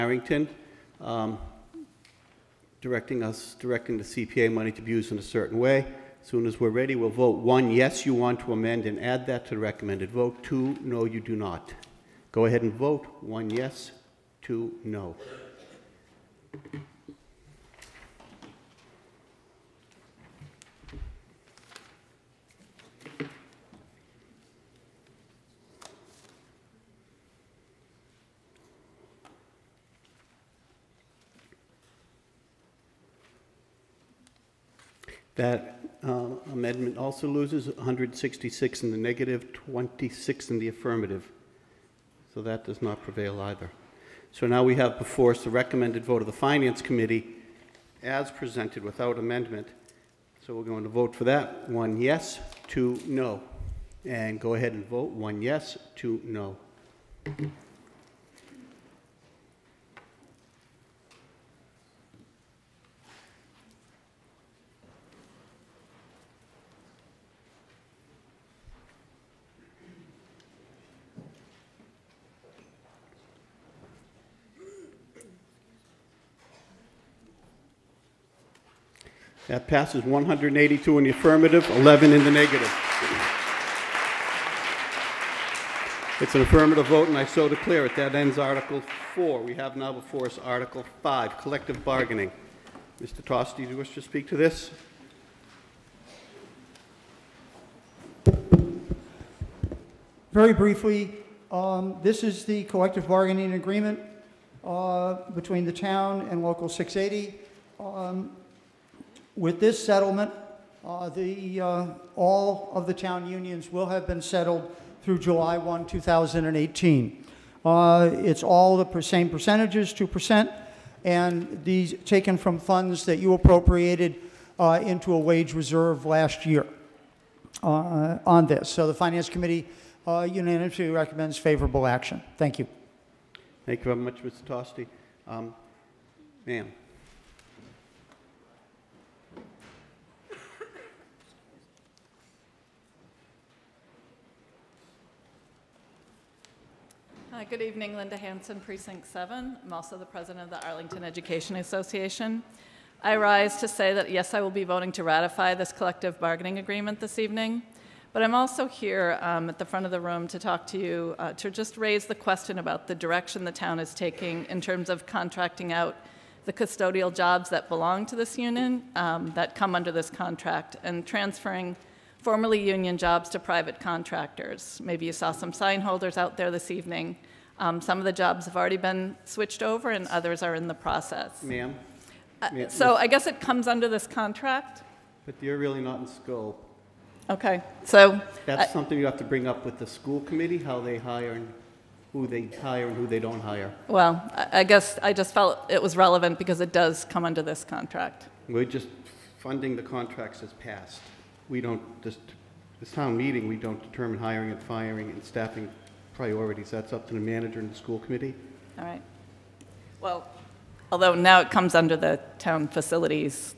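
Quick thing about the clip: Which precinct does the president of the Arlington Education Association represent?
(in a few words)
Precinct 7.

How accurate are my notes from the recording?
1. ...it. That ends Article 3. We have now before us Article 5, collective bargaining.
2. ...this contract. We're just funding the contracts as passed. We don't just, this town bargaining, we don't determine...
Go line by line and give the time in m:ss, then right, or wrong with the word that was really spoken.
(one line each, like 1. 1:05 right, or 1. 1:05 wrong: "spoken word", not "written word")
1. 1:27 wrong: "4", not "3"
2. 3:17 wrong: "meeting", not "bargaining".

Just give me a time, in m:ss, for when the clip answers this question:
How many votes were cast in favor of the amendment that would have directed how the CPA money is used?
0:39.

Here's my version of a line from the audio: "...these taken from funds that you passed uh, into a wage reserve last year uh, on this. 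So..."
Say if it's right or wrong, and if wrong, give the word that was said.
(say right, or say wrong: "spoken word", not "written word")
wrong: "appropriated", not "passed".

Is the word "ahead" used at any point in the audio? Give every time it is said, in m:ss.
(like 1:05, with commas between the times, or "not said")
0:12, 0:54.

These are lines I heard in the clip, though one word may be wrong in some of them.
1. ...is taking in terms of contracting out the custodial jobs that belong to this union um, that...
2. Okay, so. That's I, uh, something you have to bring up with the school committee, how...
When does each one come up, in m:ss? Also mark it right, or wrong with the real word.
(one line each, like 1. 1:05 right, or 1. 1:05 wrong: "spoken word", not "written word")
1. 2:43 right
2. 3:07 right.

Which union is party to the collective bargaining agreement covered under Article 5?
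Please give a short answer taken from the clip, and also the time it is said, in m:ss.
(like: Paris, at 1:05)
Local 680, at 1:46.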